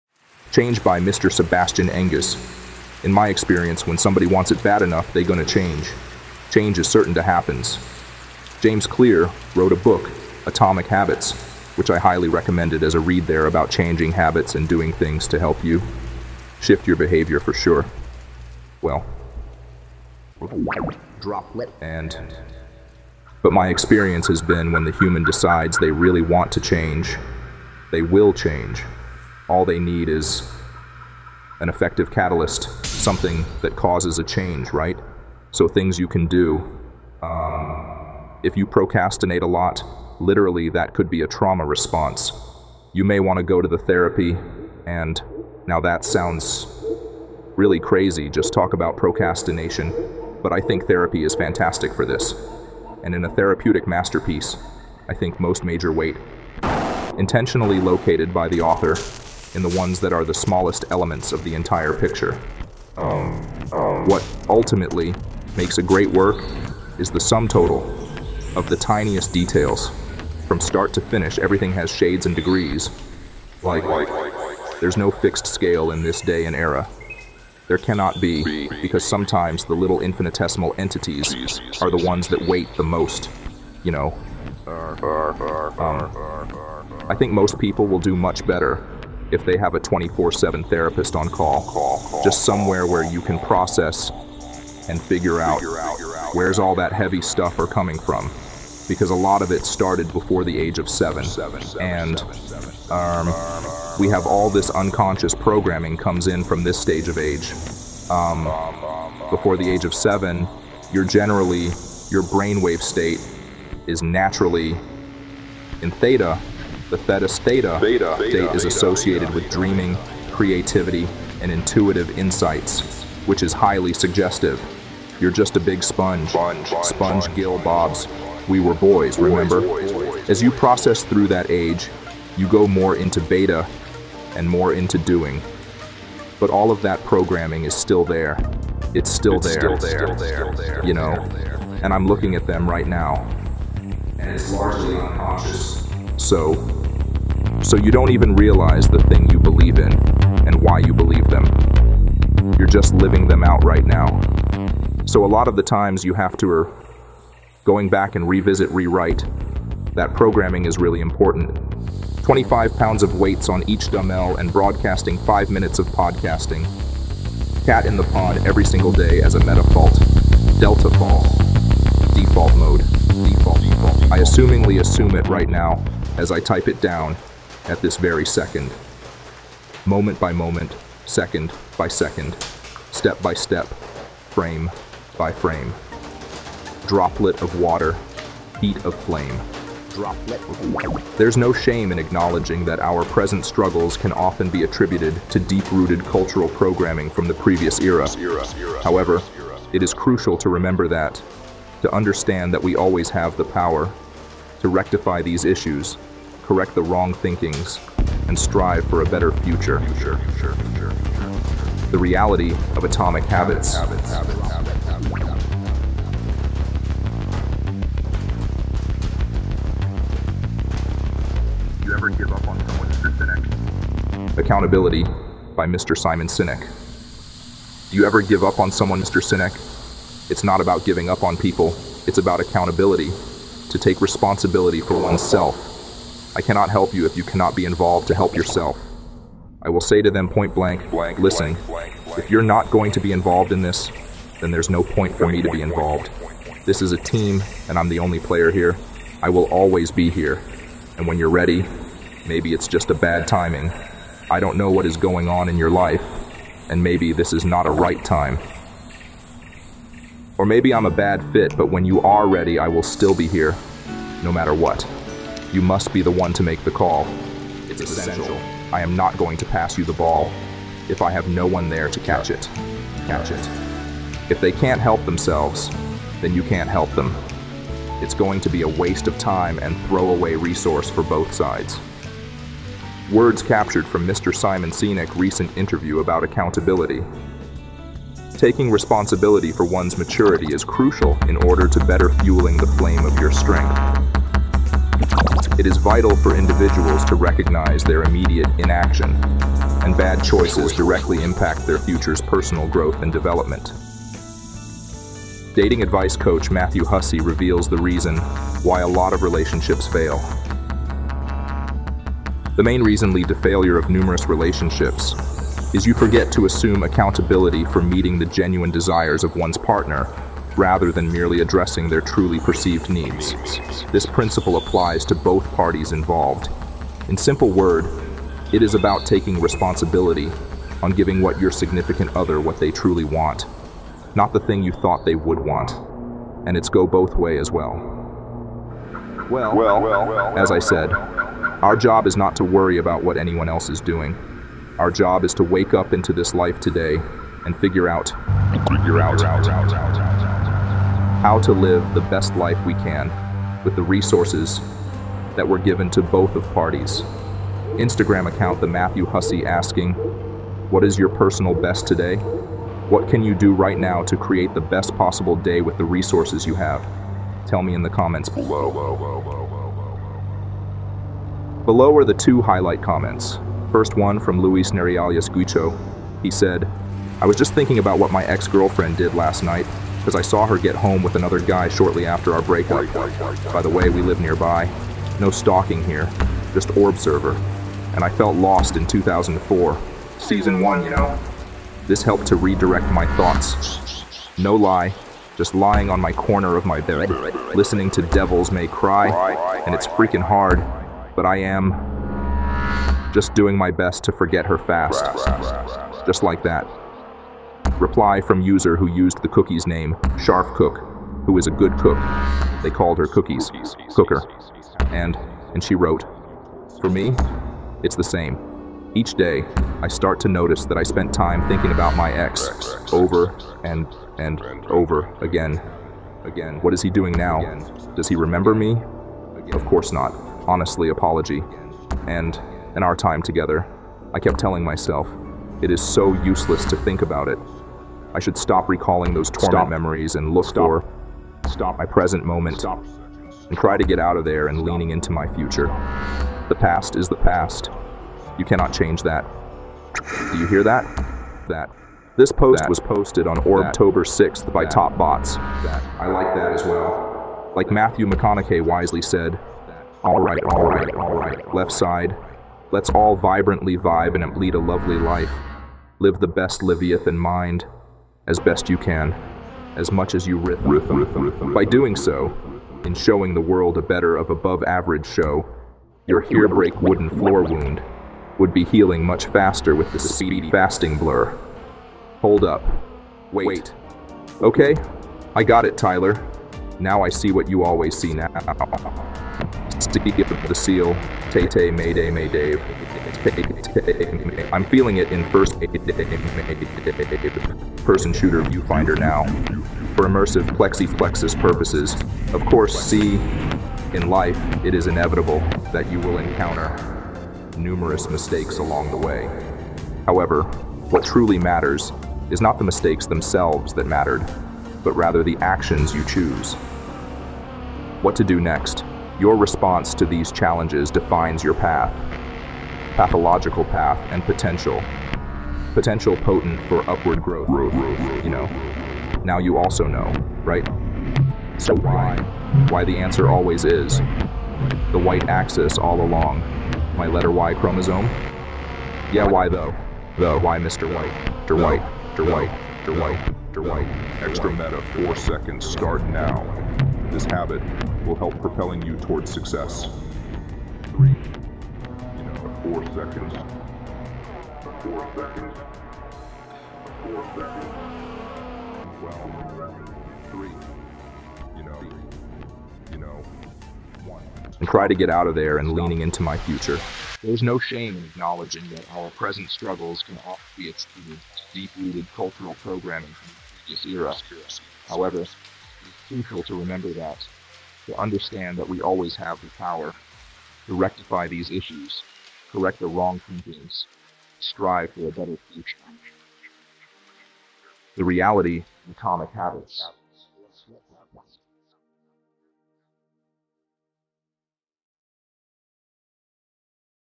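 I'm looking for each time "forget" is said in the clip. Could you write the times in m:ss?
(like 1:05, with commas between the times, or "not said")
5:15, 6:44.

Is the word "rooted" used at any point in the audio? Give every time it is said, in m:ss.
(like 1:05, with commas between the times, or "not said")
3:15, 9:31.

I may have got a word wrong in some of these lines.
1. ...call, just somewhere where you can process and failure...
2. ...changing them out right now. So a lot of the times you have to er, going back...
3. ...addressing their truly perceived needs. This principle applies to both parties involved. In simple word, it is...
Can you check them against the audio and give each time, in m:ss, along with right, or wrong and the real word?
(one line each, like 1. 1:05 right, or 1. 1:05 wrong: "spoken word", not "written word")
1. 1:31 wrong: "figure", not "failure"
2. 2:32 wrong: "living", not "changing"
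3. 5:21 right.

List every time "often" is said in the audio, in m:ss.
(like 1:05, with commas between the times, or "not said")
3:14, 9:30.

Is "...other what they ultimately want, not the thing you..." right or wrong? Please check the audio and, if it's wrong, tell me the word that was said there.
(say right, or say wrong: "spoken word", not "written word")
wrong: "truly", not "ultimately".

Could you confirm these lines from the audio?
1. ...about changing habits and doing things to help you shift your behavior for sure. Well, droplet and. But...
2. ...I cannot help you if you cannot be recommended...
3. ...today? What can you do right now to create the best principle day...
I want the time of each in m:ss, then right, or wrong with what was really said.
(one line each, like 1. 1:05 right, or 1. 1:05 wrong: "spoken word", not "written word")
1. 0:13 right
2. 3:56 wrong: "involved", not "recommended"
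3. 6:01 wrong: "possible", not "principle".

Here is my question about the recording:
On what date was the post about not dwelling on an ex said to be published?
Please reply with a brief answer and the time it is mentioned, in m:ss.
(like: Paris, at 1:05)
October 6th, at 7:33.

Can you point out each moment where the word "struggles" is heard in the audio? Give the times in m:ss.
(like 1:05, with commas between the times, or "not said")
3:13, 9:29.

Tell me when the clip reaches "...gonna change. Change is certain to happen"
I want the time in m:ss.
0:05.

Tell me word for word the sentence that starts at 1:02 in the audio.
What ultimately makes a great work is the sum total of the tiniest details.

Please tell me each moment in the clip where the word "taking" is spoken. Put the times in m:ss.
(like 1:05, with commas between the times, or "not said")
4:48, 5:29.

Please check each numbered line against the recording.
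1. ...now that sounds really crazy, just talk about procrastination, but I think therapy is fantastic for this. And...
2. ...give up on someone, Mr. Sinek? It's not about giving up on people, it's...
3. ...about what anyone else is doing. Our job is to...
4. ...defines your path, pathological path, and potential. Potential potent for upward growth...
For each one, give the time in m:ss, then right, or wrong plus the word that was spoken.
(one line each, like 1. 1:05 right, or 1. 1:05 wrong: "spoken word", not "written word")
1. 0:45 right
2. 3:48 right
3. 5:42 right
4. 8:40 right.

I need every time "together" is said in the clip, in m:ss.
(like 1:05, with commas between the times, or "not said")
7:13.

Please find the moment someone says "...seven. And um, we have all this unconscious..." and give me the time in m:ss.
1:40.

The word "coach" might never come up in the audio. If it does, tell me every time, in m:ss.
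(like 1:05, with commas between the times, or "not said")
5:06.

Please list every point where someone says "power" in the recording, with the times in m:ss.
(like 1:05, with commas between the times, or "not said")
3:23, 9:39.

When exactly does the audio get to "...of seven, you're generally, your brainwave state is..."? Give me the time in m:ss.
1:49.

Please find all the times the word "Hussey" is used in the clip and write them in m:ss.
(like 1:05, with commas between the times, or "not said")
5:06, 5:59.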